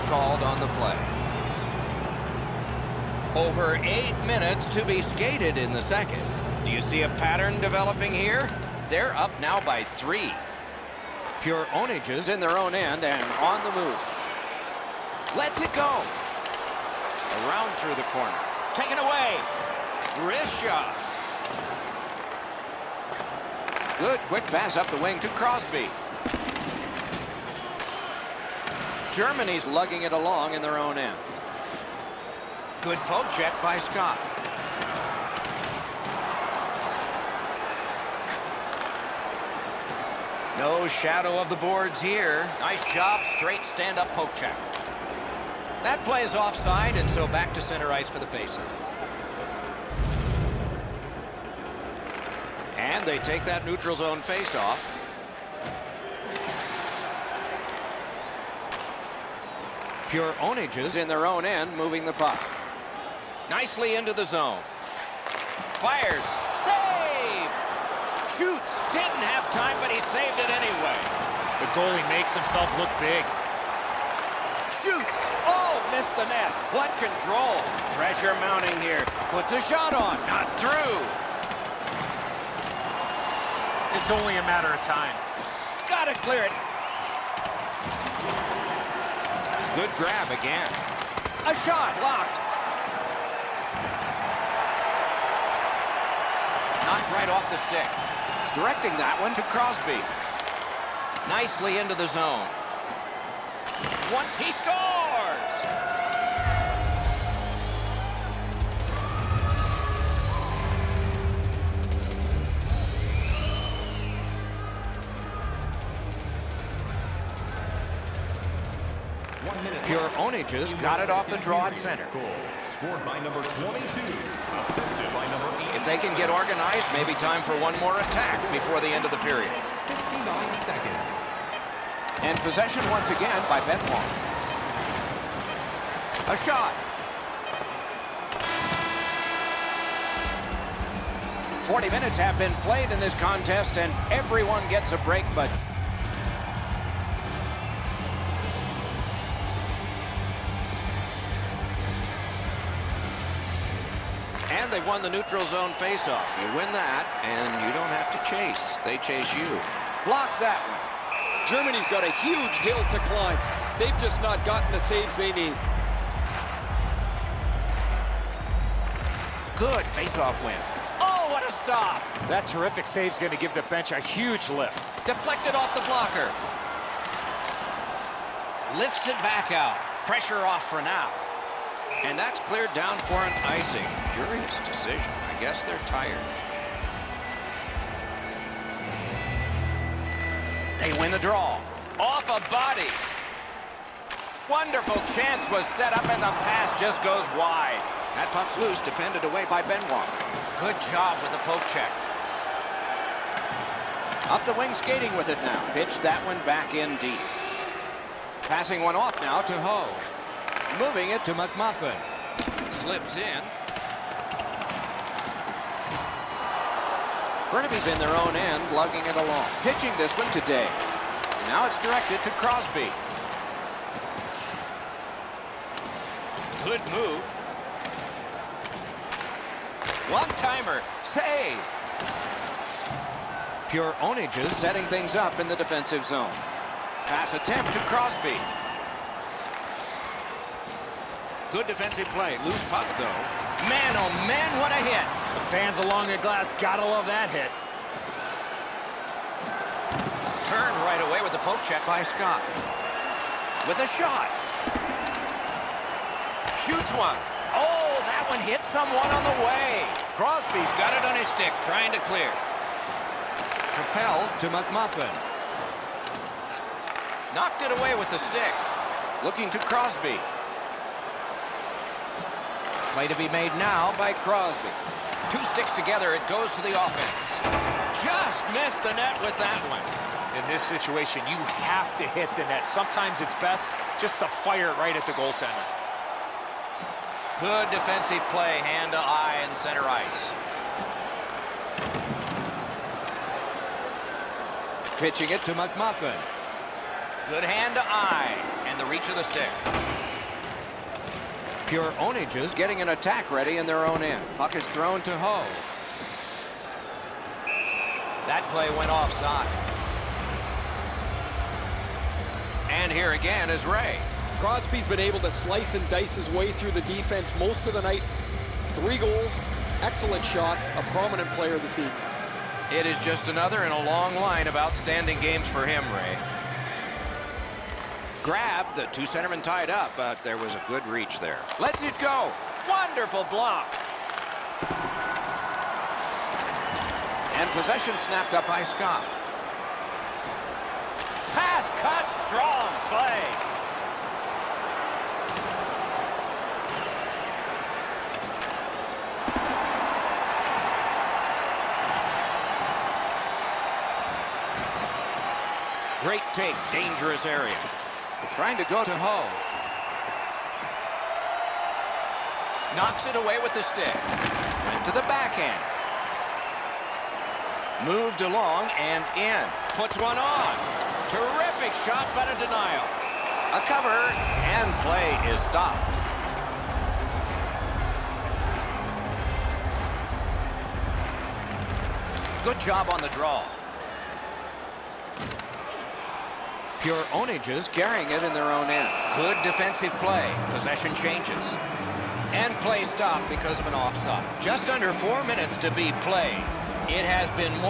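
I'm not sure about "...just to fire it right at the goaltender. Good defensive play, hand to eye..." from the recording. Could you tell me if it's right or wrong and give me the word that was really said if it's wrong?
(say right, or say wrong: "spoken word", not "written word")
right.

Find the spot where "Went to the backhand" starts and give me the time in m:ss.
6:04.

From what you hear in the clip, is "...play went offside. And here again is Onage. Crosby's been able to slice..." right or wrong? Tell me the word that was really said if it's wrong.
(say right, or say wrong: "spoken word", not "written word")
wrong: "Ray", not "Onage".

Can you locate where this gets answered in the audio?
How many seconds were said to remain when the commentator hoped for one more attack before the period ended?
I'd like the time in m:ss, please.
2:09.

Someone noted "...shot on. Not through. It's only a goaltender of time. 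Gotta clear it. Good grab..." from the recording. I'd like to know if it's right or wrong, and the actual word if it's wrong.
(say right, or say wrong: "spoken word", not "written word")
wrong: "matter", not "goaltender".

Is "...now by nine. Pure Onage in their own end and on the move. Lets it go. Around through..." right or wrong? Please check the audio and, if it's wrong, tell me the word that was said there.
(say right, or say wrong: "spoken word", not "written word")
wrong: "three", not "nine".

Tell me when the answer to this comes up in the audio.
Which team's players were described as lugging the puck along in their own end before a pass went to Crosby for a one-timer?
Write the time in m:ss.
3:37.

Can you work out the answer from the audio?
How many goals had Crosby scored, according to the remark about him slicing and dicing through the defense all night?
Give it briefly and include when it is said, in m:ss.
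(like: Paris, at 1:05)
3, at 5:18.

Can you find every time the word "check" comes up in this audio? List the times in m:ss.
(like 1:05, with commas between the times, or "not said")
0:33, 0:44, 3:21, 4:11.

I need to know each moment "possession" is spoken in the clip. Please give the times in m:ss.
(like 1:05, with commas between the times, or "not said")
2:12, 5:37, 6:30.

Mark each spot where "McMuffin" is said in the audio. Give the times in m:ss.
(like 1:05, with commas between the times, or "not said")
3:31, 4:24, 4:55.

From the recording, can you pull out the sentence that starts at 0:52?
And they take that neutral zone faceoff.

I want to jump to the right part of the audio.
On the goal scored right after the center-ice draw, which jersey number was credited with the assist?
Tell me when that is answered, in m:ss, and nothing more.
2:05.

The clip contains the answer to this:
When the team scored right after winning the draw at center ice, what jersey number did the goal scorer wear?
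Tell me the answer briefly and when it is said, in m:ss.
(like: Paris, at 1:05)
22, at 2:03.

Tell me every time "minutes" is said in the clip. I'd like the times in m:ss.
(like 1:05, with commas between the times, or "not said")
0:04, 2:21, 6:35.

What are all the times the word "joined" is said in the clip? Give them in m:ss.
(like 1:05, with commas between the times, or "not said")
not said.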